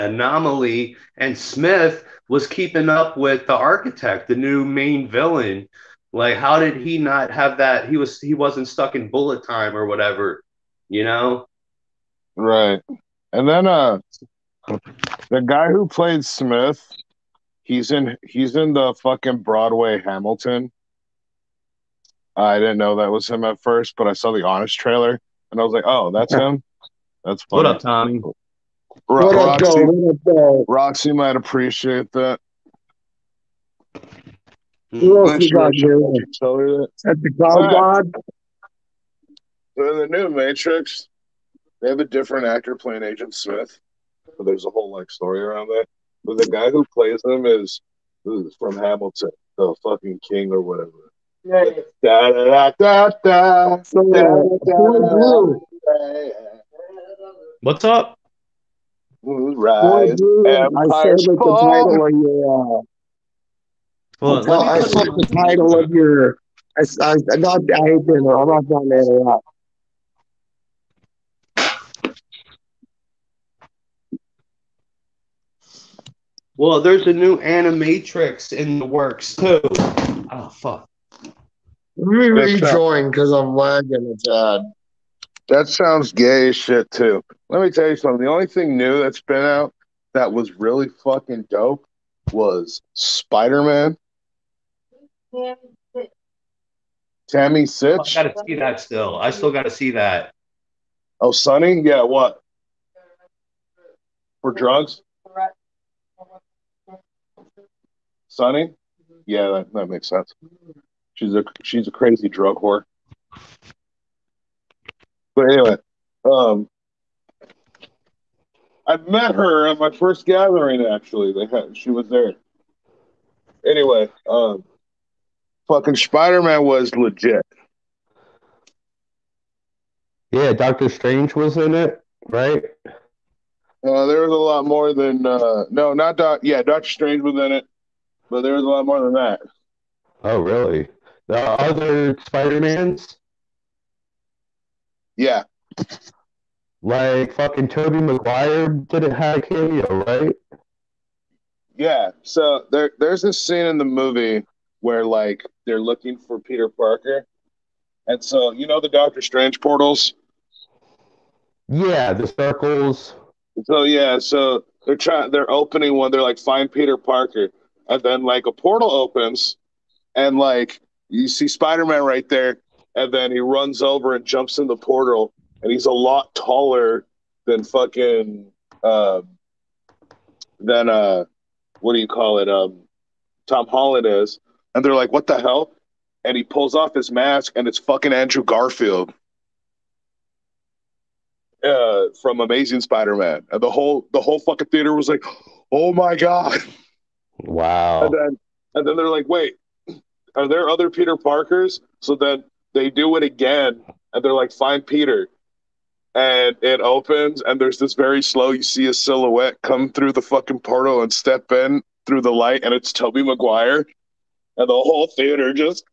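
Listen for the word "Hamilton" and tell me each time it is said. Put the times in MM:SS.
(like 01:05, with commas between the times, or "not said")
00:20, 00:48.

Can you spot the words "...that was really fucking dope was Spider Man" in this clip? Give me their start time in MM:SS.
01:30.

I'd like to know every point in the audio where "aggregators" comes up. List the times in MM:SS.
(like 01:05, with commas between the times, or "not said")
not said.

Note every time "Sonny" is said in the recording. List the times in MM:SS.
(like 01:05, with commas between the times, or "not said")
01:41, 01:48.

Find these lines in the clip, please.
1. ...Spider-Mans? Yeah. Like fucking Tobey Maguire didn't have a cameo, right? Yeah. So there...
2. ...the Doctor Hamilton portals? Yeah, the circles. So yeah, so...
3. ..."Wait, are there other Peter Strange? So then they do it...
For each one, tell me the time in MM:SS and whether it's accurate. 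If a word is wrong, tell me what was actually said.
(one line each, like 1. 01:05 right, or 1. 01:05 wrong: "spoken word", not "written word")
1. 02:22 right
2. 02:38 wrong: "Strange", not "Hamilton"
3. 03:19 wrong: "Parkers", not "Strange".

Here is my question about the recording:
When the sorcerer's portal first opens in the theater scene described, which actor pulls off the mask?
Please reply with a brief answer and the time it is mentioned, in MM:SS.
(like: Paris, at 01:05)
Andrew Garfield, at 03:08.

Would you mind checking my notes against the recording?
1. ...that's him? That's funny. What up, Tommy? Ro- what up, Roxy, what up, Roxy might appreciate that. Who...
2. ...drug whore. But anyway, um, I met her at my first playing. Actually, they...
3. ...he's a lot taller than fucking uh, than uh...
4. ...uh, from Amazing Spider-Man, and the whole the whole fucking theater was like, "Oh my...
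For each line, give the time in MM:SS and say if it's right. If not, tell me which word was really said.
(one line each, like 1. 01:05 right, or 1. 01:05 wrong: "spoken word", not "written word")
1. 00:26 right
2. 01:52 wrong: "gathering", not "playing"
3. 02:55 right
4. 03:11 right.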